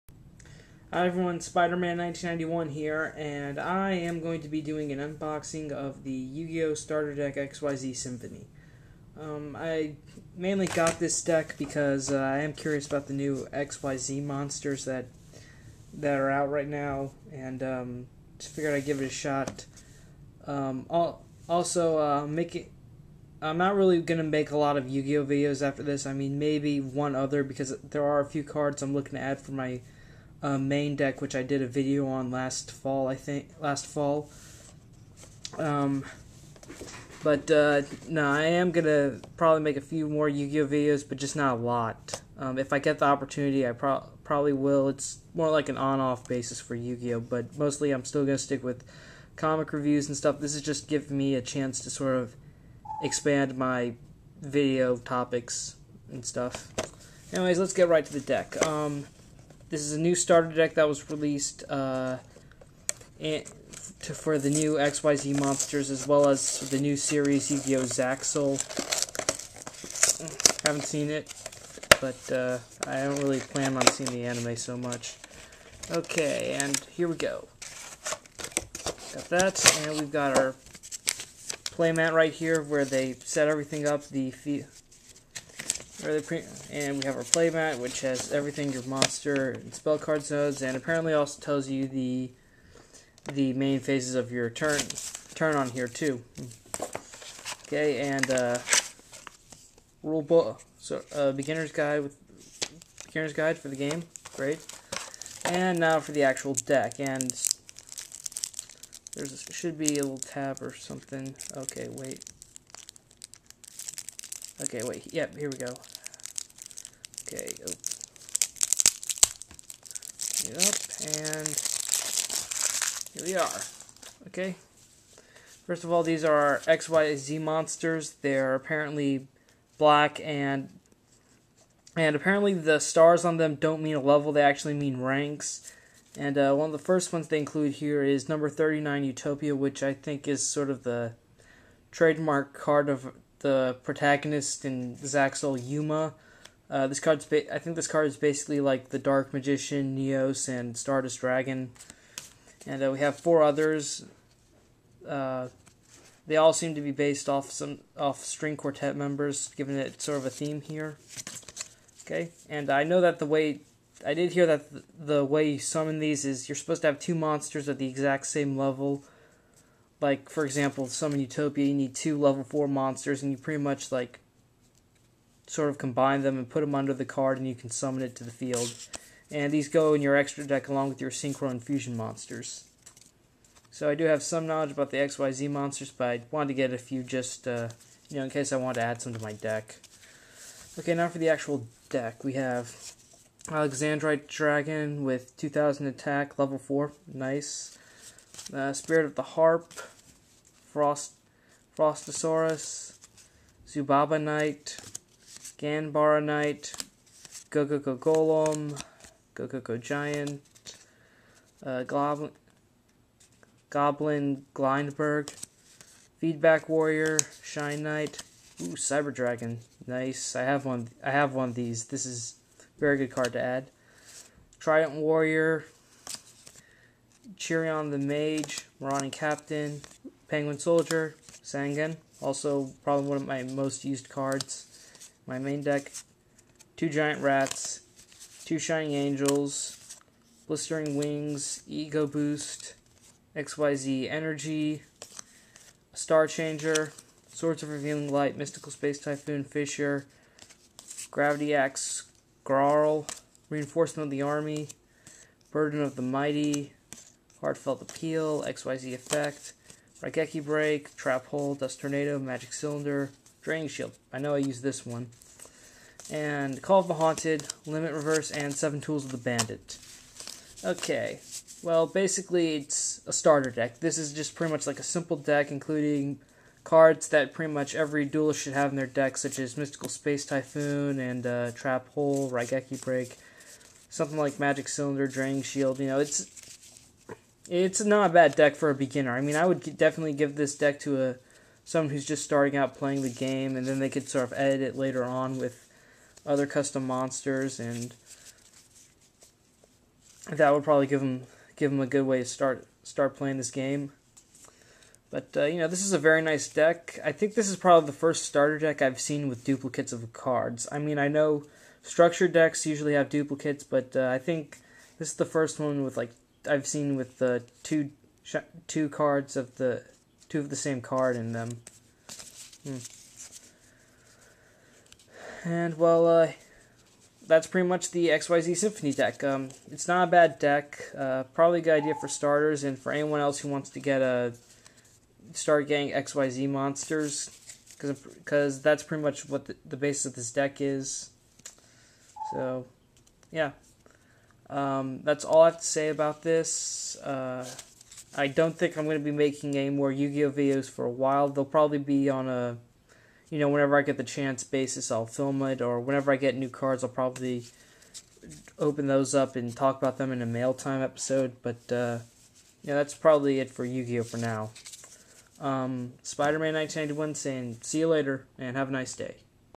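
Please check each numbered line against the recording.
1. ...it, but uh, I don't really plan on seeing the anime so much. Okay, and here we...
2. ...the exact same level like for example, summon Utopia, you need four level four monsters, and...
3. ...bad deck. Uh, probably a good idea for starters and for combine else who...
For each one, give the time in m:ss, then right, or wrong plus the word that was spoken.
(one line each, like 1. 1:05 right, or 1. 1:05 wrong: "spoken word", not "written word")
1. 1:11 right
2. 2:47 wrong: "two", not "four"
3. 5:30 wrong: "anyone", not "combine".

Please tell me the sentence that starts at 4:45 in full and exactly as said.
You know, it's it's not a bad deck for a beginner.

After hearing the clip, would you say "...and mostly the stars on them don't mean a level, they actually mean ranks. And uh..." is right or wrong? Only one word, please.
wrong.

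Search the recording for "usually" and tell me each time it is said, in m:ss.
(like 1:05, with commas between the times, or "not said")
5:12.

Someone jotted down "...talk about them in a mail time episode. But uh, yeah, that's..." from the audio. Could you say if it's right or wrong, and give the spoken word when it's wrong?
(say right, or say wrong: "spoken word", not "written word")
right.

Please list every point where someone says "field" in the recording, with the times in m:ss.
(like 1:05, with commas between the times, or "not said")
2:58.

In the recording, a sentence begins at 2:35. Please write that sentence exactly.
Uh, they all seem to be based off some off string quartet members, giving it sort of a theme here.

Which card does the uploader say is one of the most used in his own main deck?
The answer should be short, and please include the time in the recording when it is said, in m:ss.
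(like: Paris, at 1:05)
Sangan, at 3:51.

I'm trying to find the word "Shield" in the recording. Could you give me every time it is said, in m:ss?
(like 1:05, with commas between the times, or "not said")
4:23, 4:45.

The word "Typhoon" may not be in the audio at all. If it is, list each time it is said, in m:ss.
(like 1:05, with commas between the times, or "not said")
4:08, 4:40.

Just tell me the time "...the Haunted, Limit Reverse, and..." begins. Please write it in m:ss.
4:26.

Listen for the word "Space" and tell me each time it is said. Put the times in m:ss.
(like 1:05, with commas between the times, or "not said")
4:08, 4:39.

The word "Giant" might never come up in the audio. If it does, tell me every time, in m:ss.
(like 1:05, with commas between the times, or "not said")
3:29, 3:56.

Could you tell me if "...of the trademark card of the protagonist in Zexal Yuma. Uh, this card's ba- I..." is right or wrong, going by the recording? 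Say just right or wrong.
right.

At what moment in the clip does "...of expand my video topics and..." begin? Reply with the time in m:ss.
0:52.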